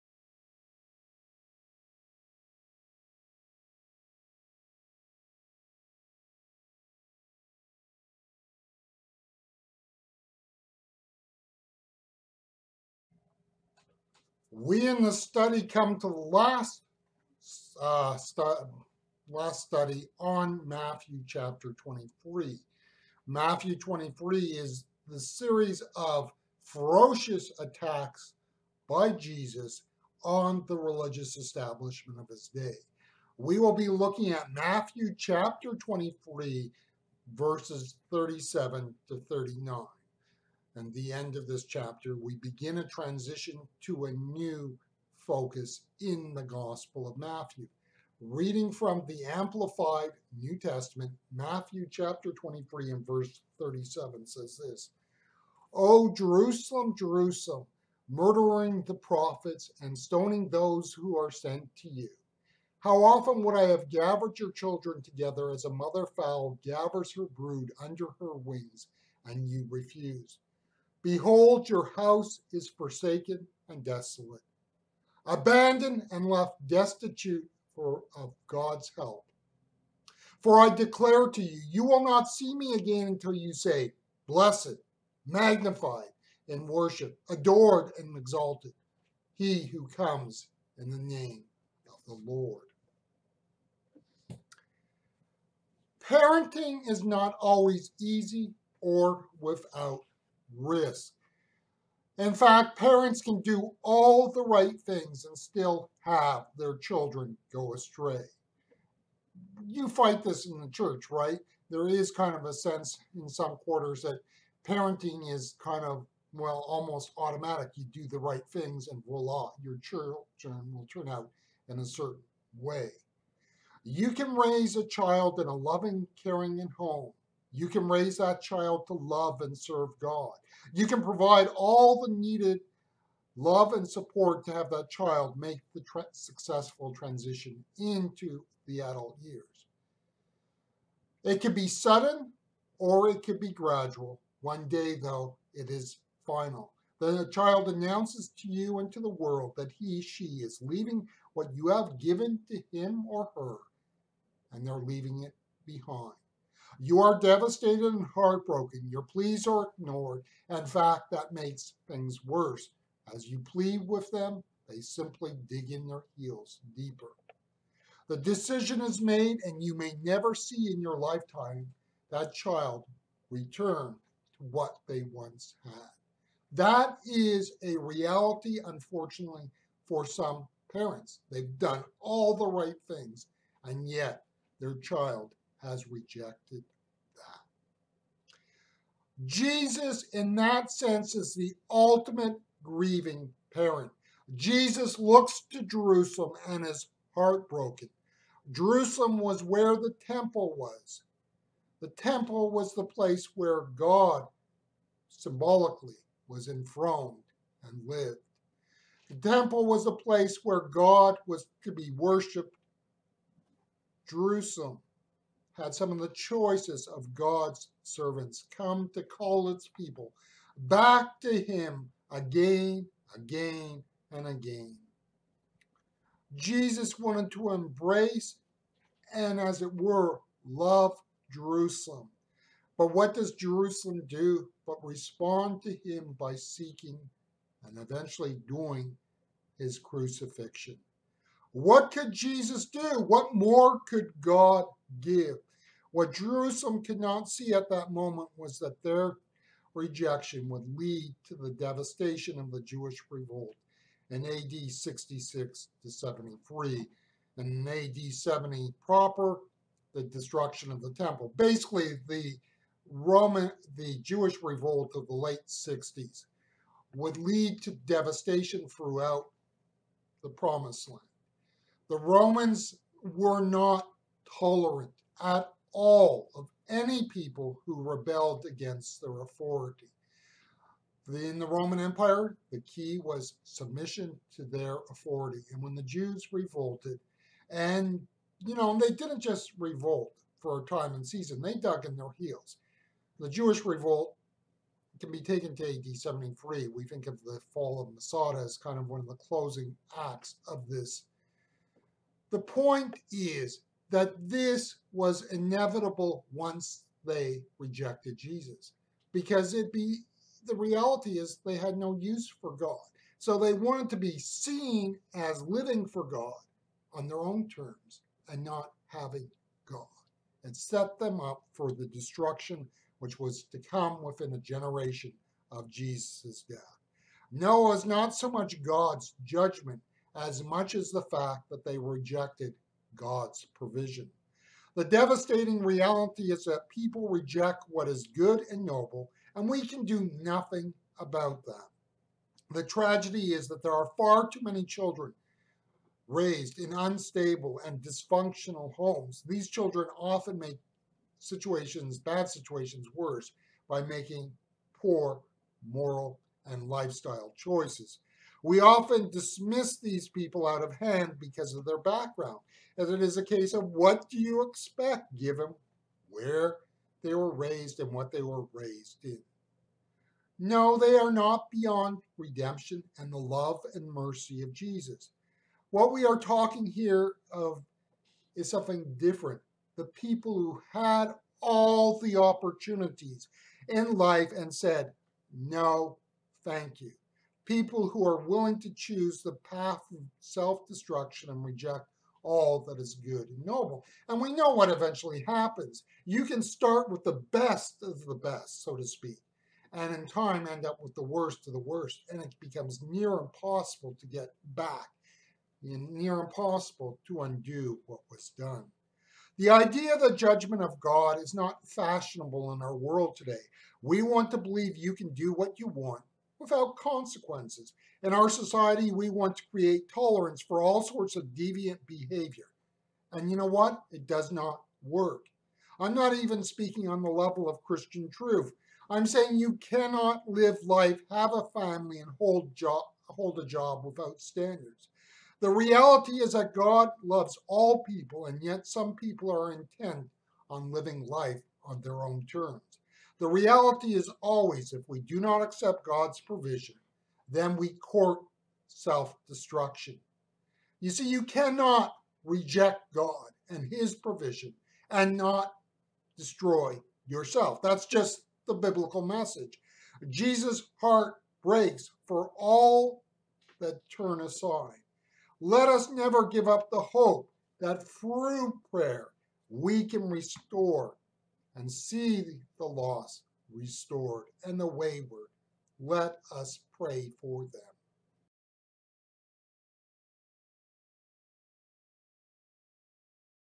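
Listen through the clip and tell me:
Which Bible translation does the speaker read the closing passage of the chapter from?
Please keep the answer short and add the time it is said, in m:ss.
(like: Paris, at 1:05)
Amplified New Testament, at 0:49.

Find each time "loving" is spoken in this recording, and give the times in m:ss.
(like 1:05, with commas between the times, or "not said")
2:05.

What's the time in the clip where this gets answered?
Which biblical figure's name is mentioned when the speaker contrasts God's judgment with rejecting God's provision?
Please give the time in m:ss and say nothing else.
5:27.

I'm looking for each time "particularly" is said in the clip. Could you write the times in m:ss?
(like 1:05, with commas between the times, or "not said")
not said.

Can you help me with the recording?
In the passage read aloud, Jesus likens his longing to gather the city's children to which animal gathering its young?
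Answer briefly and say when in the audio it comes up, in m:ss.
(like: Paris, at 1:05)
mother fowl, at 1:05.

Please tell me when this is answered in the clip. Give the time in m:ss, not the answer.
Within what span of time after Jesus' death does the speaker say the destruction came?
5:24.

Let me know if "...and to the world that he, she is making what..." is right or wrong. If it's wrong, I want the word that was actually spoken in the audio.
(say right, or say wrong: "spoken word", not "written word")
wrong: "leaving", not "making".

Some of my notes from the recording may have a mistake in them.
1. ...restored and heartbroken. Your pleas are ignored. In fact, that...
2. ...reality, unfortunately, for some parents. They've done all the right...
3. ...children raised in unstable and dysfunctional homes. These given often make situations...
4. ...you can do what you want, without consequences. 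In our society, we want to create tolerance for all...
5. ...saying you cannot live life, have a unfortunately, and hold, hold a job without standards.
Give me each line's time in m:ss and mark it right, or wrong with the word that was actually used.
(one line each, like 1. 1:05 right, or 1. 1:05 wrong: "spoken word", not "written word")
1. 2:37 wrong: "devastated", not "restored"
2. 2:57 right
3. 5:44 wrong: "children", not "given"
4. 6:54 right
5. 7:09 wrong: "family", not "unfortunately".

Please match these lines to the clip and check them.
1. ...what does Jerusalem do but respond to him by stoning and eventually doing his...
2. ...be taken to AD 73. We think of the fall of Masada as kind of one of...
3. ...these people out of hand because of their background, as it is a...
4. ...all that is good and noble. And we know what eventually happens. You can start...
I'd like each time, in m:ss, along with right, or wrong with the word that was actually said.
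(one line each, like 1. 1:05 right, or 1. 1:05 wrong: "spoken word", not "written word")
1. 3:52 wrong: "seeking", not "stoning"
2. 4:55 right
3. 5:59 right
4. 6:32 right.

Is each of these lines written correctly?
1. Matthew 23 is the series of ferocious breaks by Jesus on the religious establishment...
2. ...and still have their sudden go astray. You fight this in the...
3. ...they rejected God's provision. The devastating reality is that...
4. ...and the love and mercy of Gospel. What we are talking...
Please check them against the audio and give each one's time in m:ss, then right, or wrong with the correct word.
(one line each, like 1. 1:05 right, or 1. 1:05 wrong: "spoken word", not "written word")
1. 0:23 wrong: "attacks", not "breaks"
2. 1:45 wrong: "children", not "sudden"
3. 5:31 right
4. 6:12 wrong: "Jesus", not "Gospel".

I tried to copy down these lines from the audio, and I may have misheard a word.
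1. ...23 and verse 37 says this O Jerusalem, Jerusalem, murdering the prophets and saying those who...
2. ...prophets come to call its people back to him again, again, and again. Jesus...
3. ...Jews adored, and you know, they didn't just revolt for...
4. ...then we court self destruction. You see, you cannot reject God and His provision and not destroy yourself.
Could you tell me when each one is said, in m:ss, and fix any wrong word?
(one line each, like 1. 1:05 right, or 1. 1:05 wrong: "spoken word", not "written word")
1. 0:52 wrong: "stoning", not "saying"
2. 3:37 wrong: "servants", not "prophets"
3. 4:45 wrong: "revolted", not "adored"
4. 7:27 right.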